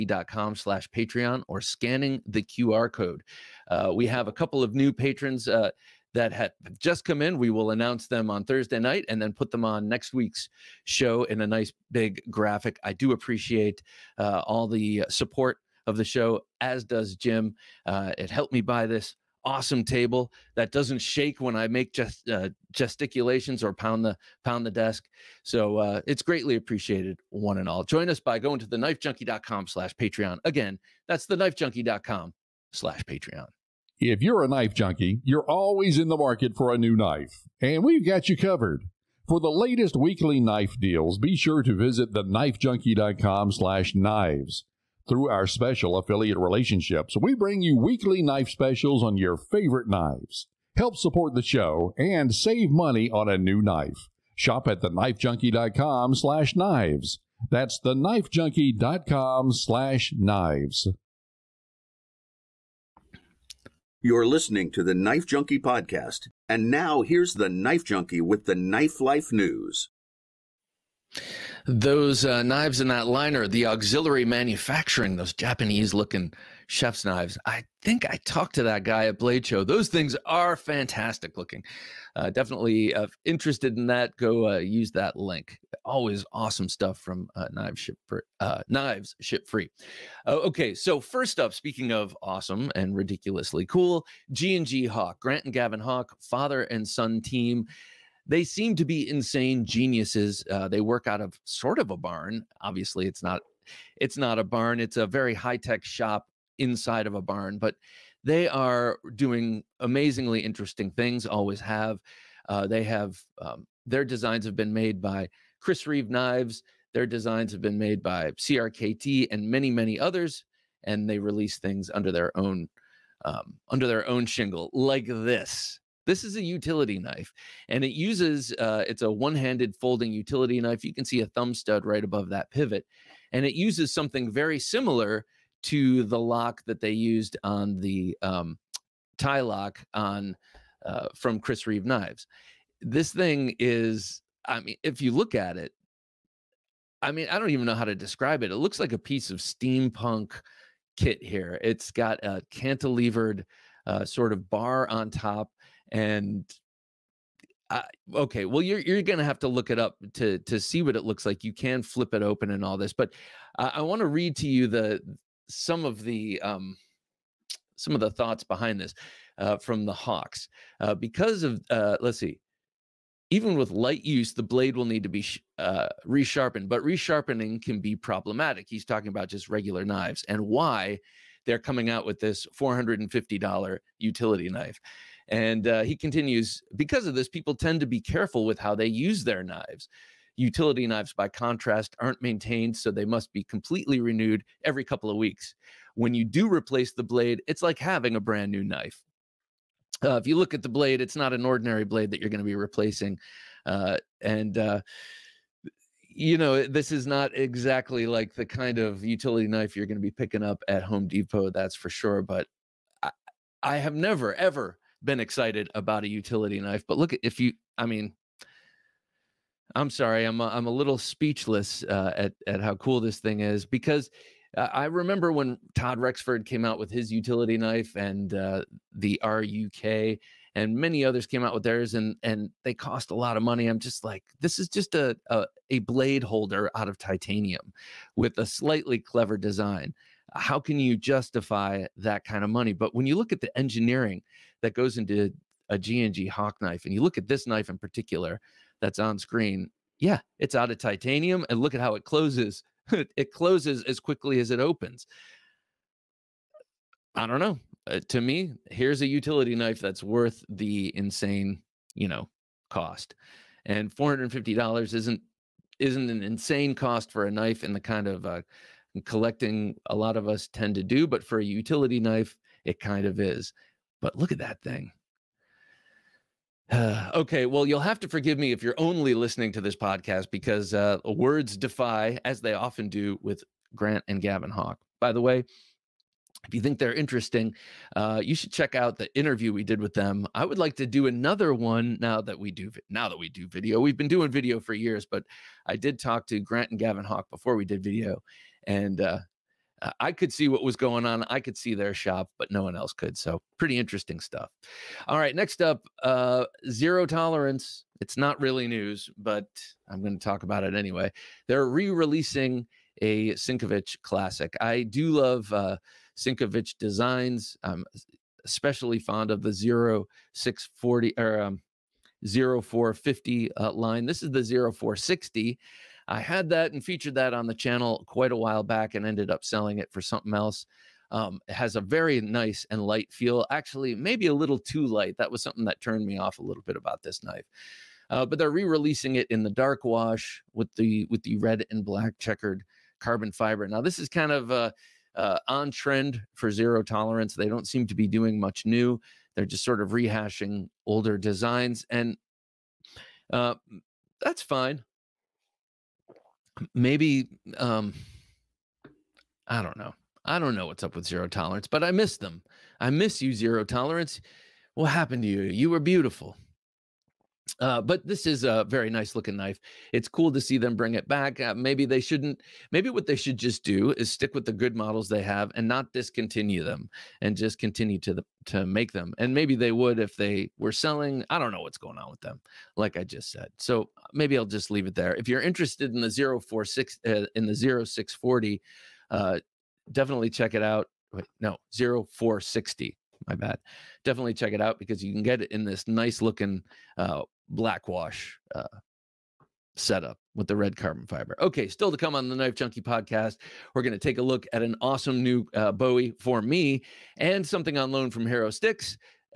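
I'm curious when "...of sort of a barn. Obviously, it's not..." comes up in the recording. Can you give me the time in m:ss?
1:41.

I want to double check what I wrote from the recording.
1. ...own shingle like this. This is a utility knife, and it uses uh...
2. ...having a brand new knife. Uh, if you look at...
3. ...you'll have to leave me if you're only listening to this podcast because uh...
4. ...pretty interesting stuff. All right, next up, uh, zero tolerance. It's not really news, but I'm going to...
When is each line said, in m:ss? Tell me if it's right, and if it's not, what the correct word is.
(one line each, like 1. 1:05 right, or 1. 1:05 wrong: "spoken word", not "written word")
1. 2:04 right
2. 3:17 right
3. 4:37 wrong: "forgive", not "leave"
4. 5:03 right.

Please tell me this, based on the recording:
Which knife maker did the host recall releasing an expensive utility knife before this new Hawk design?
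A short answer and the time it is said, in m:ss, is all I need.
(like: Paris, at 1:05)
Todd Rexford, at 3:45.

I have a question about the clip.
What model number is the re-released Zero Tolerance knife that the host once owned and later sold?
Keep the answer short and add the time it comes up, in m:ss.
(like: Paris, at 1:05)
0460, at 5:24.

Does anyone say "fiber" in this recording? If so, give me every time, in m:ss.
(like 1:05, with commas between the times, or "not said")
5:43, 6:41.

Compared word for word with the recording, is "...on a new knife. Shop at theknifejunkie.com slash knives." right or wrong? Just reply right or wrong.
right.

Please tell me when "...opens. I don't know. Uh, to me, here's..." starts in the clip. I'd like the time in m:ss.
4:14.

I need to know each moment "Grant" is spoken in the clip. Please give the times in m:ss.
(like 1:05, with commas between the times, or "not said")
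1:35, 4:43, 4:56.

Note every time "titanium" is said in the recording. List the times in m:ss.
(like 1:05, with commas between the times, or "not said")
3:56, 4:10.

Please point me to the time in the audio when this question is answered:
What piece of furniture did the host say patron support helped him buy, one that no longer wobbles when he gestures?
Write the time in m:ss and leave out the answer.
0:19.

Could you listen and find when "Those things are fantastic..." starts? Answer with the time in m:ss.
1:19.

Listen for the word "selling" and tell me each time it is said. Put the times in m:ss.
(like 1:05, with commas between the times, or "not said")
5:29, 6:20.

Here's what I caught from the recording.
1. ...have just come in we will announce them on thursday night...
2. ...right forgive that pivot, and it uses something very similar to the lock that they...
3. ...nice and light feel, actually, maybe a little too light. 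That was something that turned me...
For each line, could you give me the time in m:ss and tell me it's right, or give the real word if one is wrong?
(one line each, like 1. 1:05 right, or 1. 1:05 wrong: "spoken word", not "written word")
1. 0:06 right
2. 2:11 wrong: "above", not "forgive"
3. 5:32 right.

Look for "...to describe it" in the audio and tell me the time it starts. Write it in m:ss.
2:27.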